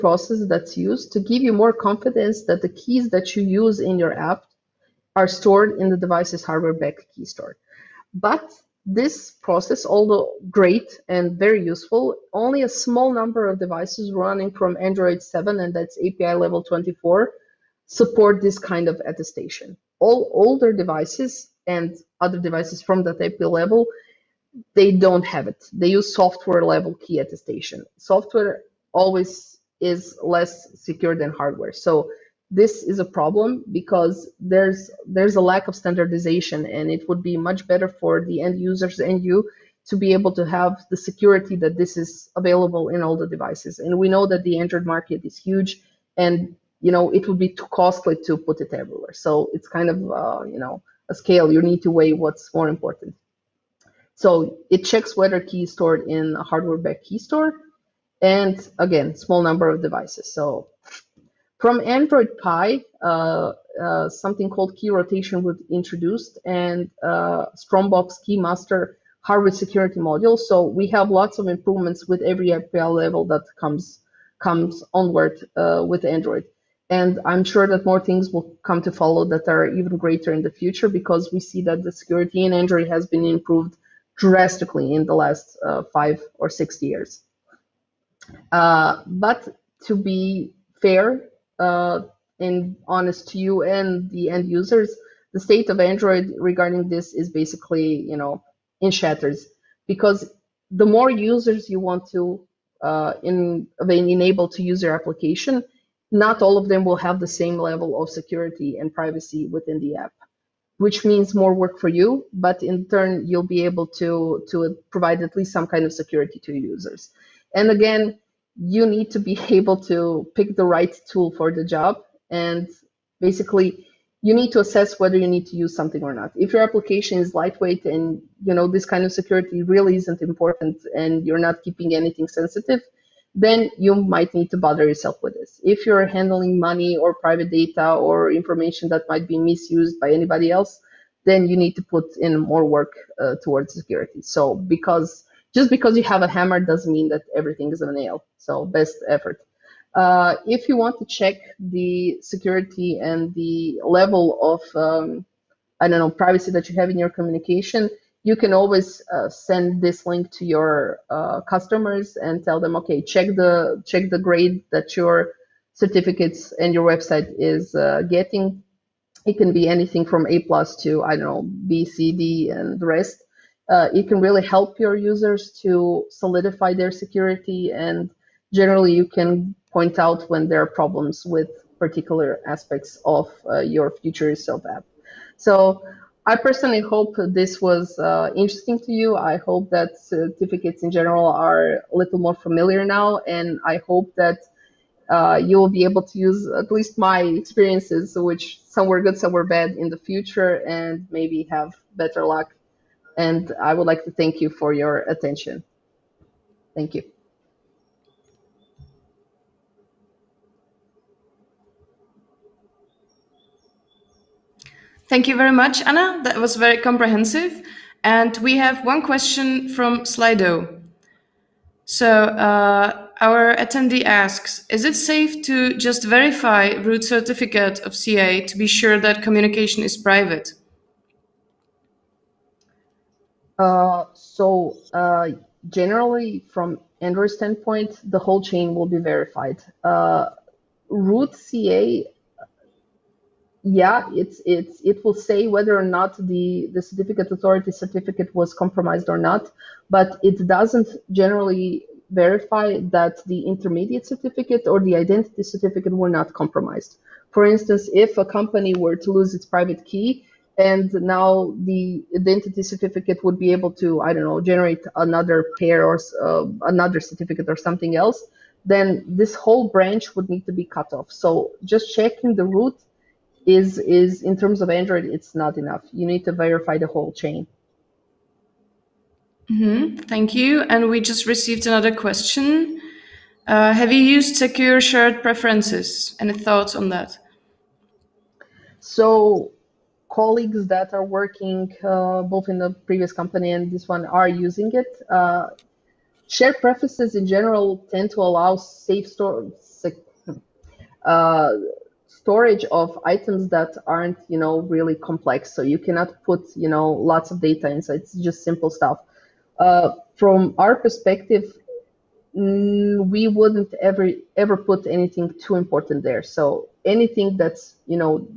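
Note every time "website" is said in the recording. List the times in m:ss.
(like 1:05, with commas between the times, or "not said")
2:46.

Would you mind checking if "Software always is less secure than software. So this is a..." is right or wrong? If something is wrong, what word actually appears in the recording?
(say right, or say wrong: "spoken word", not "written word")
wrong: "hardware", not "software".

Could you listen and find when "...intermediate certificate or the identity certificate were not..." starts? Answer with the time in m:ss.
4:13.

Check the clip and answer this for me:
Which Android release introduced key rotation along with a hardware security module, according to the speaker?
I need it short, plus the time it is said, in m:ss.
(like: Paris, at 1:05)
Android Pie, at 1:01.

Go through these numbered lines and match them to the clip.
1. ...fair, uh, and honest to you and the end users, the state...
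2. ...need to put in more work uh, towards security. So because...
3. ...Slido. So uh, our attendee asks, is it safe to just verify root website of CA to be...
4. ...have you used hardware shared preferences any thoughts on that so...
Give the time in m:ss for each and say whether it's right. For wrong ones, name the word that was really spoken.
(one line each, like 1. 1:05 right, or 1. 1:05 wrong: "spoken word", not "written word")
1. 1:30 right
2. 2:21 right
3. 3:40 wrong: "certificate", not "website"
4. 4:43 wrong: "secure", not "hardware".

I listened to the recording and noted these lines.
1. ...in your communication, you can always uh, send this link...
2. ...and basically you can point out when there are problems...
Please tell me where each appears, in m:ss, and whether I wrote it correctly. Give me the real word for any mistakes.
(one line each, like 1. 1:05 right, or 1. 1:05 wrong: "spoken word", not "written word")
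1. 2:36 right
2. 2:57 wrong: "generally", not "basically".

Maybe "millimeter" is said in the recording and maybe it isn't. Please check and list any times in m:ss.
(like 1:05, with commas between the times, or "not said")
not said.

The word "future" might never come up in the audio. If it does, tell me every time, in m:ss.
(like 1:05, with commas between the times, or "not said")
1:20, 3:04, 3:19.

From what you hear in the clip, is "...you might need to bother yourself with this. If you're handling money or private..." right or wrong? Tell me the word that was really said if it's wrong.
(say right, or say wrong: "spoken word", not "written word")
right.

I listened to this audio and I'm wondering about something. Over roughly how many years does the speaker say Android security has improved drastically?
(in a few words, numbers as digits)
five or six years.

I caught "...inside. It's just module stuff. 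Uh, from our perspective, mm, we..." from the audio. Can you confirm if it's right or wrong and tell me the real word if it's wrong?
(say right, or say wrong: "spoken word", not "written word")
wrong: "simple", not "module".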